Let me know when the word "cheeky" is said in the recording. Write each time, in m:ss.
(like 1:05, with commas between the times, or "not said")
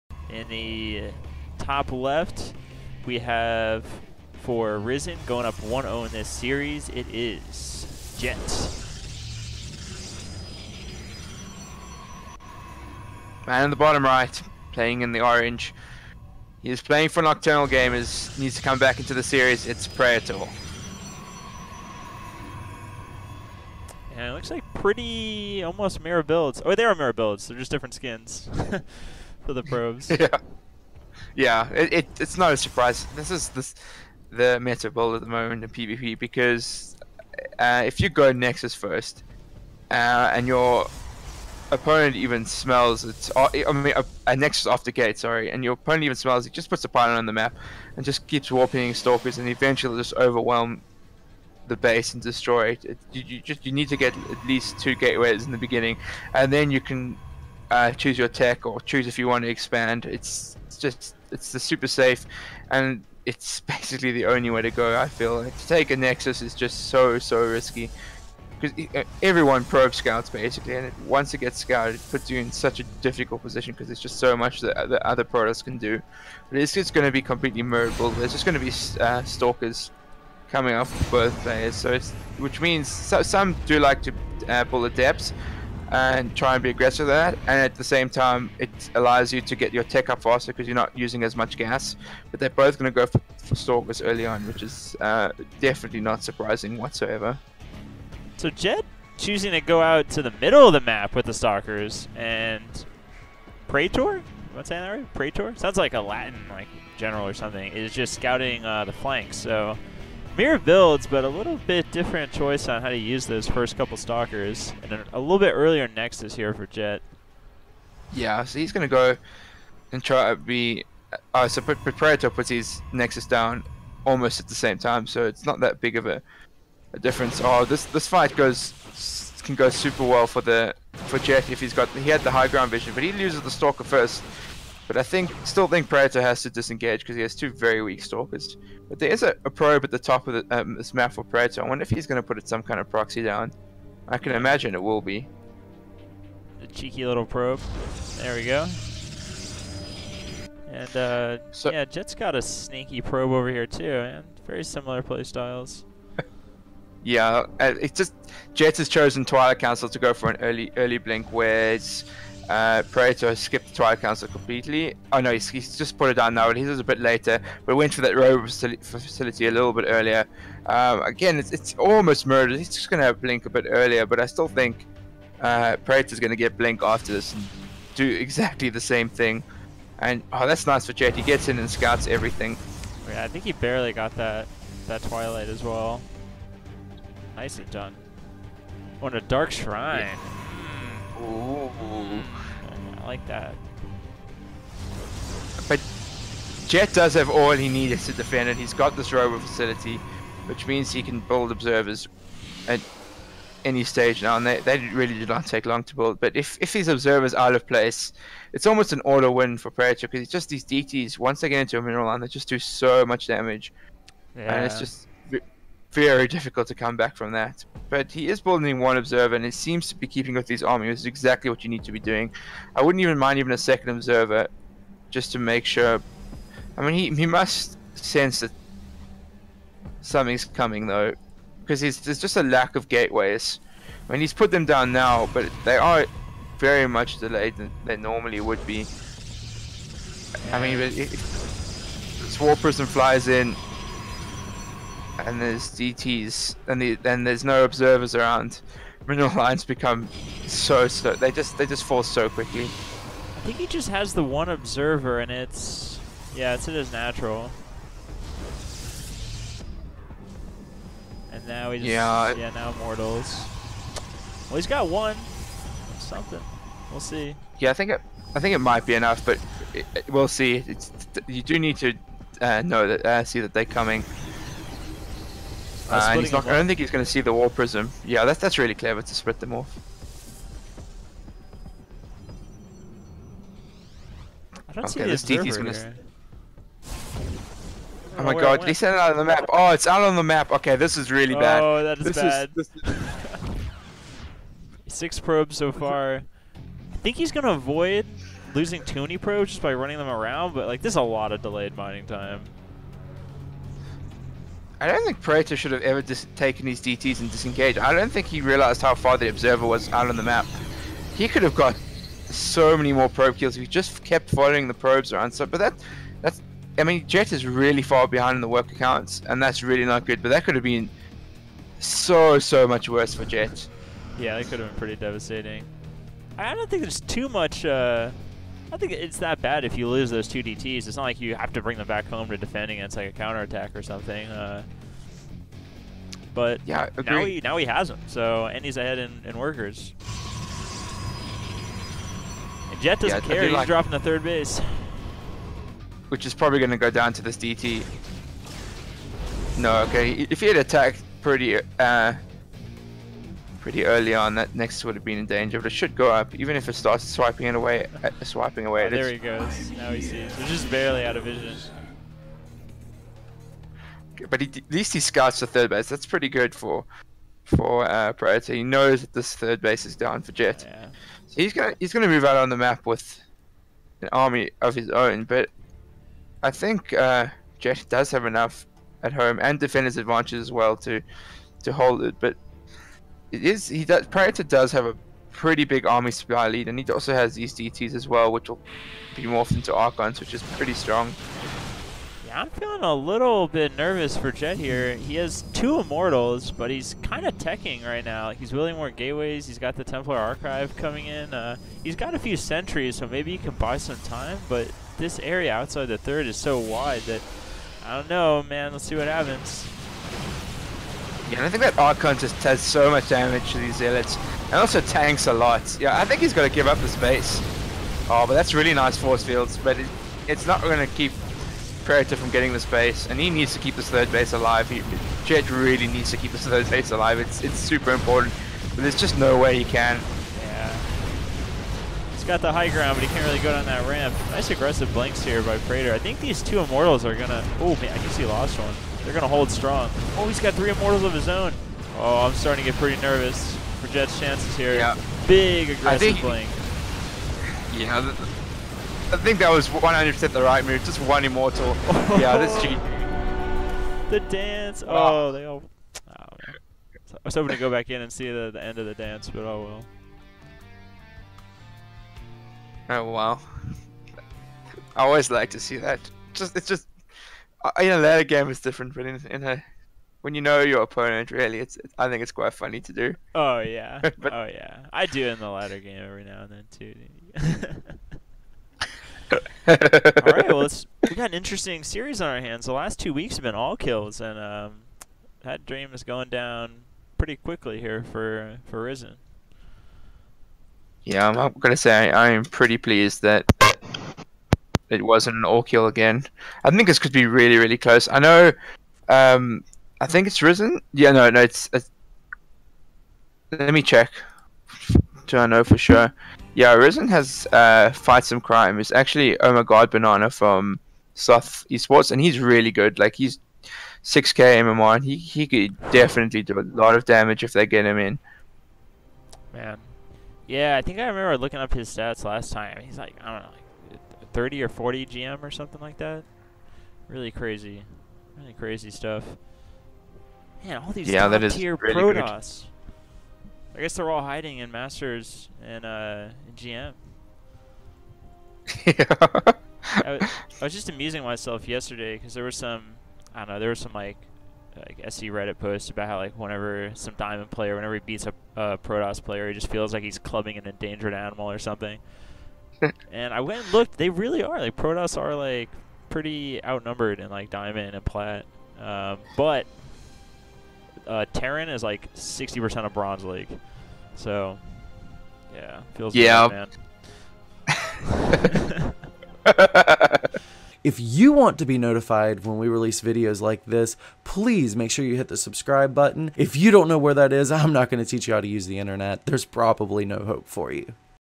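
2:26.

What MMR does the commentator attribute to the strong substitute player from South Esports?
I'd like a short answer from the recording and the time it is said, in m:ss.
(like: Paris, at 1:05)
6k, at 8:34.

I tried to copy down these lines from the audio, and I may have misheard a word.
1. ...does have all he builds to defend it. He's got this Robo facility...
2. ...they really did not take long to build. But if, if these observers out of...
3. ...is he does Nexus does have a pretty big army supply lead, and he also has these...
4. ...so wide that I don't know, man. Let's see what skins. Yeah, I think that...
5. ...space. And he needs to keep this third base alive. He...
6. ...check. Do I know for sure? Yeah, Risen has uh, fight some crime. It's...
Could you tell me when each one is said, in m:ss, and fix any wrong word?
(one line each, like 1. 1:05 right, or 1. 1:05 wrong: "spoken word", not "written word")
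1. 3:16 wrong: "needs", not "builds"
2. 3:24 right
3. 6:23 wrong: "Praetor", not "Nexus"
4. 6:46 wrong: "happens", not "skins"
5. 7:02 right
6. 8:23 right.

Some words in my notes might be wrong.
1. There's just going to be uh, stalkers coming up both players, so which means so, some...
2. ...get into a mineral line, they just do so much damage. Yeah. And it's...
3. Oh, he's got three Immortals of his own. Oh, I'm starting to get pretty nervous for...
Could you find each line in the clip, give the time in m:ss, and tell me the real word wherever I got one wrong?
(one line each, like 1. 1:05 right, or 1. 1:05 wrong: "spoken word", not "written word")
1. 1:18 right
2. 3:31 right
3. 7:20 right.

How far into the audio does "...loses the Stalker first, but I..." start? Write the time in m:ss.
2:13.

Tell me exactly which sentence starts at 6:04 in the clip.
But he, at least he scouts the third base.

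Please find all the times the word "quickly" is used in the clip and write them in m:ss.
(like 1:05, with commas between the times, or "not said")
4:12, 8:07.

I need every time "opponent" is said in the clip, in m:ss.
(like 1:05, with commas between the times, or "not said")
0:41, 0:45, 7:50.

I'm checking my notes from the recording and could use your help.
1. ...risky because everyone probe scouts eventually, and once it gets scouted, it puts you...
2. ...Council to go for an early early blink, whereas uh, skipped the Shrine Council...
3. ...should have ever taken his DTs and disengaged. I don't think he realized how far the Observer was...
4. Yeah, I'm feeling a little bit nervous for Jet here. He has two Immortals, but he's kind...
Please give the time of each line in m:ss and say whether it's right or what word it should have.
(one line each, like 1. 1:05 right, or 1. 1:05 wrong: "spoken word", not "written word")
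1. 1:07 wrong: "basically", not "eventually"
2. 2:39 wrong: "Twilight", not "Shrine"
3. 5:05 right
4. 6:32 right.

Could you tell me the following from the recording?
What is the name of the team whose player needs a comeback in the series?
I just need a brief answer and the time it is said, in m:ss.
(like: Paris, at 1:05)
Nocturnal Gamers, at 0:17.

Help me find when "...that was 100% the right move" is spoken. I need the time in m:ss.
7:29.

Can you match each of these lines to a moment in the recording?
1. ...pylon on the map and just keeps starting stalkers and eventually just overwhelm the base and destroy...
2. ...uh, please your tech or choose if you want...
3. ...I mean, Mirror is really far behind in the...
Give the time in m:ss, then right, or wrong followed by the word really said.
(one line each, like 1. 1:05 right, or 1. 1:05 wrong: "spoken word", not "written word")
1. 0:46 wrong: "warping", not "starting"
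2. 0:57 wrong: "choose", not "please"
3. 5:16 wrong: "Jet", not "Mirror".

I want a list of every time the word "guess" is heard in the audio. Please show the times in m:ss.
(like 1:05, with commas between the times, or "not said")
7:18, 8:53.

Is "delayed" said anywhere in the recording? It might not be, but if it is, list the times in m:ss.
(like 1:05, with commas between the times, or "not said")
3:57, 5:01.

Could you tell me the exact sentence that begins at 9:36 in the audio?
If you don't know where that is, I'm not going to teach you how to use the internet.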